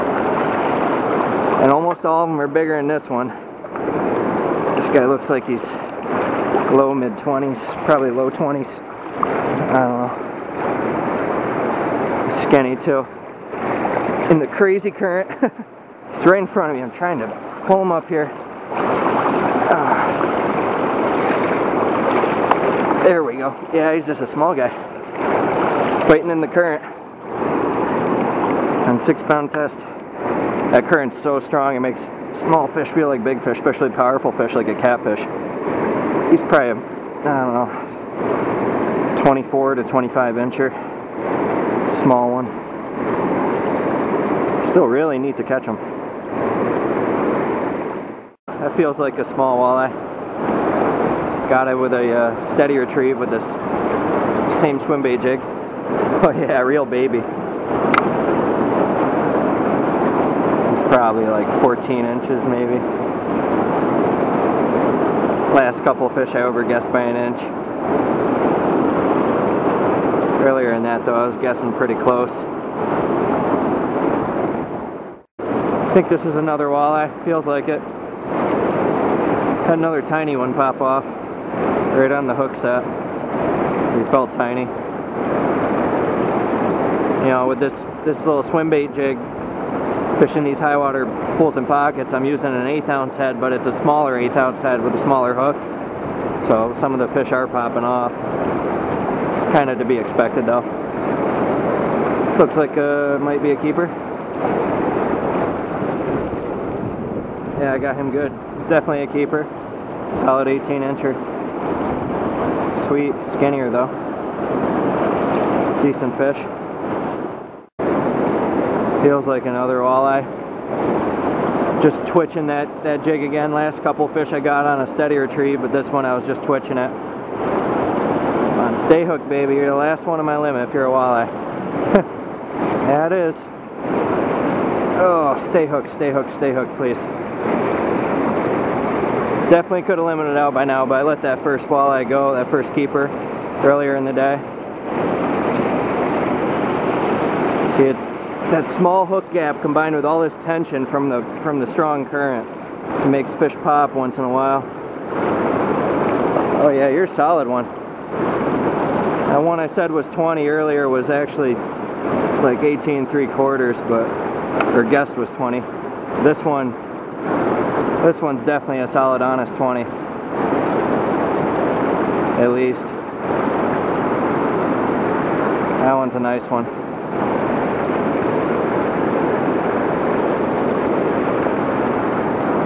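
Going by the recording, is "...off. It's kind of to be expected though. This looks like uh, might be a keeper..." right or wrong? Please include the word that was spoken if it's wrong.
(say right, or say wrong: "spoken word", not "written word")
right.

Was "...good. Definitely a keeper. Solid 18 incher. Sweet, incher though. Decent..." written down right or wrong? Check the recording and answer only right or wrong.
wrong.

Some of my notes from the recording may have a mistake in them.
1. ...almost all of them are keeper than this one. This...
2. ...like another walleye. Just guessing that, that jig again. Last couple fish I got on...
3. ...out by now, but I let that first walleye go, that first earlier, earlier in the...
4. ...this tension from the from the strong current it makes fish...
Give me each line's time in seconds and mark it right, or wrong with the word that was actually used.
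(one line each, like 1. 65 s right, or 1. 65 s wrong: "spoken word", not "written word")
1. 1 s wrong: "bigger", not "keeper"
2. 119 s wrong: "twitching", not "guessing"
3. 140 s wrong: "keeper", not "earlier"
4. 150 s right.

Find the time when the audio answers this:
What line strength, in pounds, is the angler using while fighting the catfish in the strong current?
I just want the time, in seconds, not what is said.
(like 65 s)
29 s.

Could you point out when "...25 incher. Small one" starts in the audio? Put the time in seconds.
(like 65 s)
39 s.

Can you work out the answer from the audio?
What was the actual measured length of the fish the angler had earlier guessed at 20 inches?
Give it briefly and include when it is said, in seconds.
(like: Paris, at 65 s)
18 3/4 inches, at 162 s.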